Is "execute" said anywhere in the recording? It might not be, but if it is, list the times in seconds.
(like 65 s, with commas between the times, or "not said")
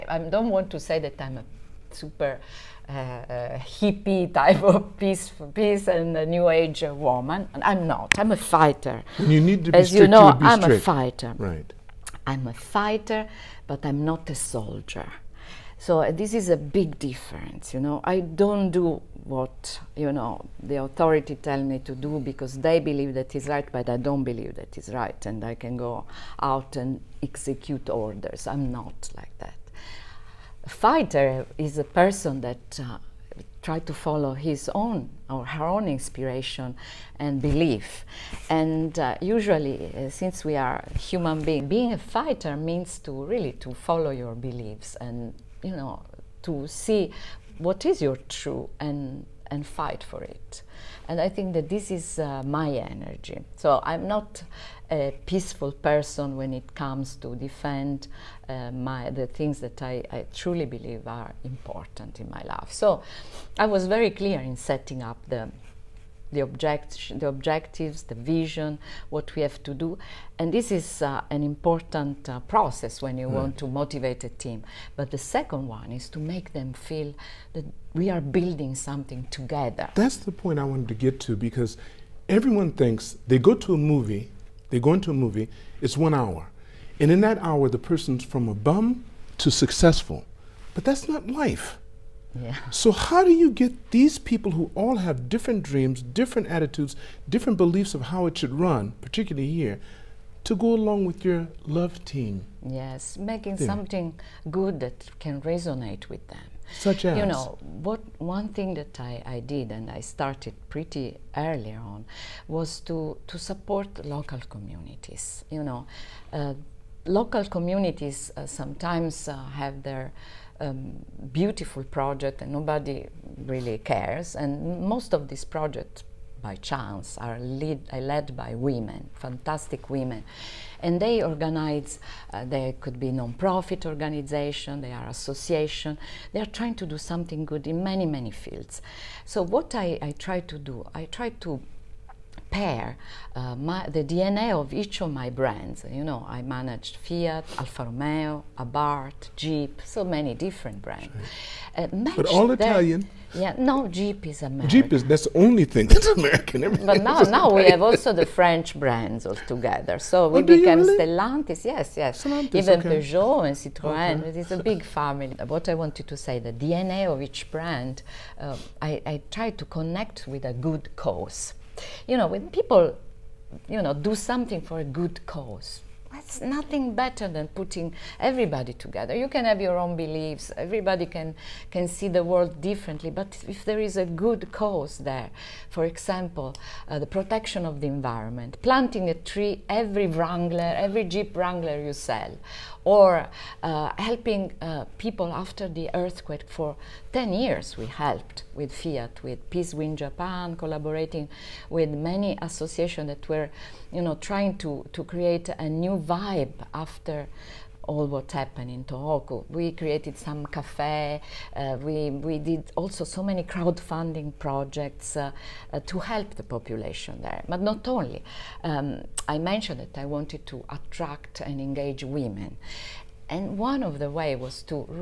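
27 s.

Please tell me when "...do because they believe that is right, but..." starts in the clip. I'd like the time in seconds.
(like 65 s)
21 s.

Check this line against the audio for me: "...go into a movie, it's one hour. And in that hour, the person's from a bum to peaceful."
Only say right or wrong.
wrong.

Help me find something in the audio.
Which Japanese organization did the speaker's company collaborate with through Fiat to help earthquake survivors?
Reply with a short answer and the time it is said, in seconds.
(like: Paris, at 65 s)
Peace Winds Japan, at 199 s.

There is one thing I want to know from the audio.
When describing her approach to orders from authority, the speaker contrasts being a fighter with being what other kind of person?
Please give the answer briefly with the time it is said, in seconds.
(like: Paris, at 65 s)
soldier, at 14 s.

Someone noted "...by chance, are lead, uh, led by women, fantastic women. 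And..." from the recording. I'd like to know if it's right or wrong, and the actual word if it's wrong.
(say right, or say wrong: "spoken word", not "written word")
right.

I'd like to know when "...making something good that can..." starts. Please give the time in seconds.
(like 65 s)
103 s.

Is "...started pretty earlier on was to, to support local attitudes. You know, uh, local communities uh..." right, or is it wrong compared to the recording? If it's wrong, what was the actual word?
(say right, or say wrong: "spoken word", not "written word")
wrong: "communities", not "attitudes".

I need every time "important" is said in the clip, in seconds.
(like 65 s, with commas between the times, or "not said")
61 s, 71 s.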